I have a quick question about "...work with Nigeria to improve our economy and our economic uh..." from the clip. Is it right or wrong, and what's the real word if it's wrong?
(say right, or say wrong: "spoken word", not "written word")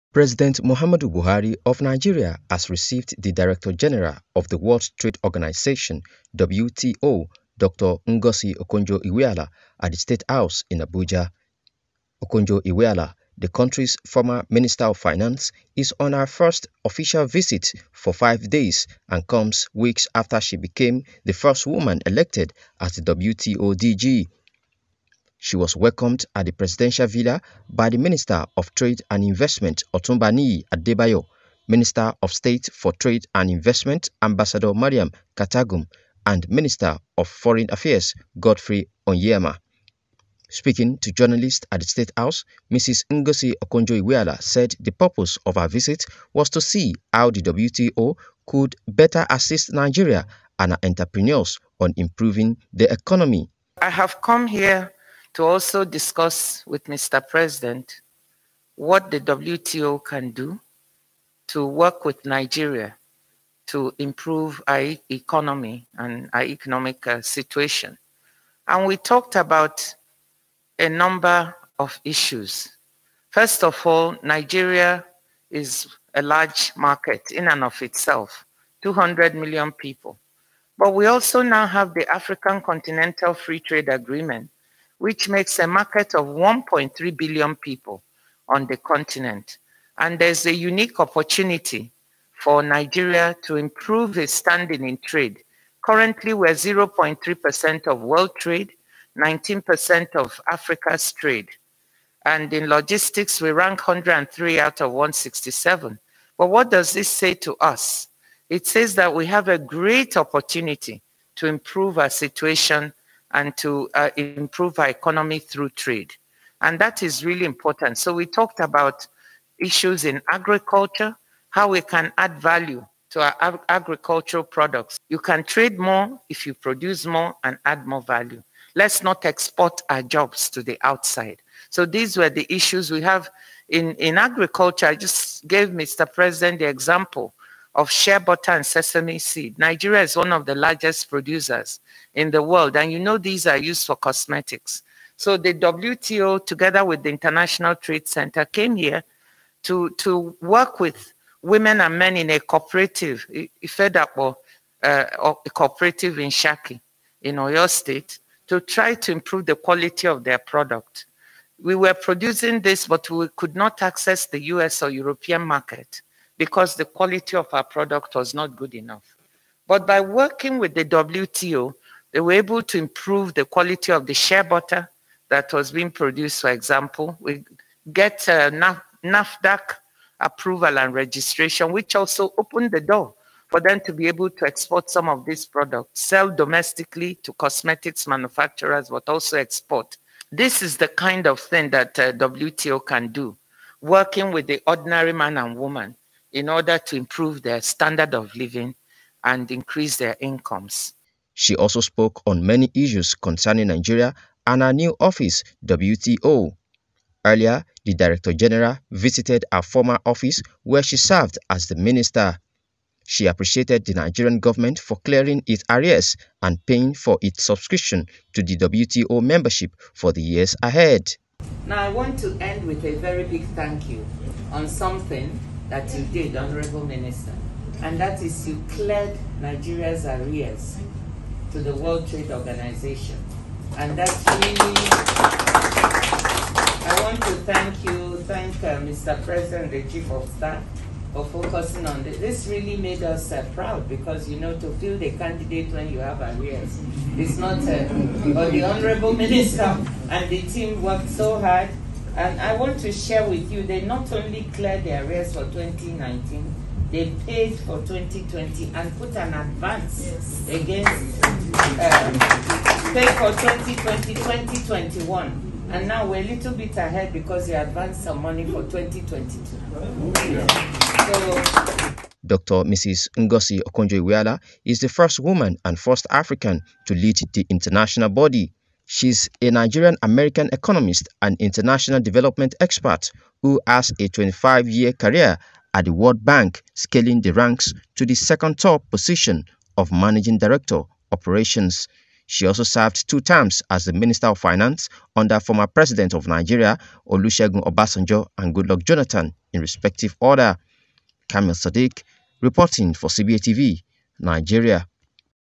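right.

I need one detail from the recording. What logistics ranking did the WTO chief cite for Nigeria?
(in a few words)
103.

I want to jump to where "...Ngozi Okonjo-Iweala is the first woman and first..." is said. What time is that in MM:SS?
04:33.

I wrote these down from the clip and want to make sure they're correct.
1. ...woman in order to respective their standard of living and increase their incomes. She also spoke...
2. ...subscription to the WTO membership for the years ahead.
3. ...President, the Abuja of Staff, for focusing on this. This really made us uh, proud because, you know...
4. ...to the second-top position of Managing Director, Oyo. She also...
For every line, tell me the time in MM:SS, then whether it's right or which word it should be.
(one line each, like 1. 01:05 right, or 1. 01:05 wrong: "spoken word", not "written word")
1. 03:15 wrong: "improve", not "respective"
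2. 03:37 right
3. 03:59 wrong: "Chief", not "Abuja"
4. 04:47 wrong: "Operations", not "Oyo".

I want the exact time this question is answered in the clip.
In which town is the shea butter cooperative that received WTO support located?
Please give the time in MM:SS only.
02:36.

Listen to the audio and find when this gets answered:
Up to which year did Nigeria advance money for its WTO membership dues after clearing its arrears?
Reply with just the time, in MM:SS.
04:28.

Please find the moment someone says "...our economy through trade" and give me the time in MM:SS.
01:54.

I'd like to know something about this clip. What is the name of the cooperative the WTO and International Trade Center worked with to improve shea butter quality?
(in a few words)
Ifedapo.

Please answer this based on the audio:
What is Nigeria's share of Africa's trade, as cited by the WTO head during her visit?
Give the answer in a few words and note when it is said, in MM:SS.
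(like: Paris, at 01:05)
19%, at 01:39.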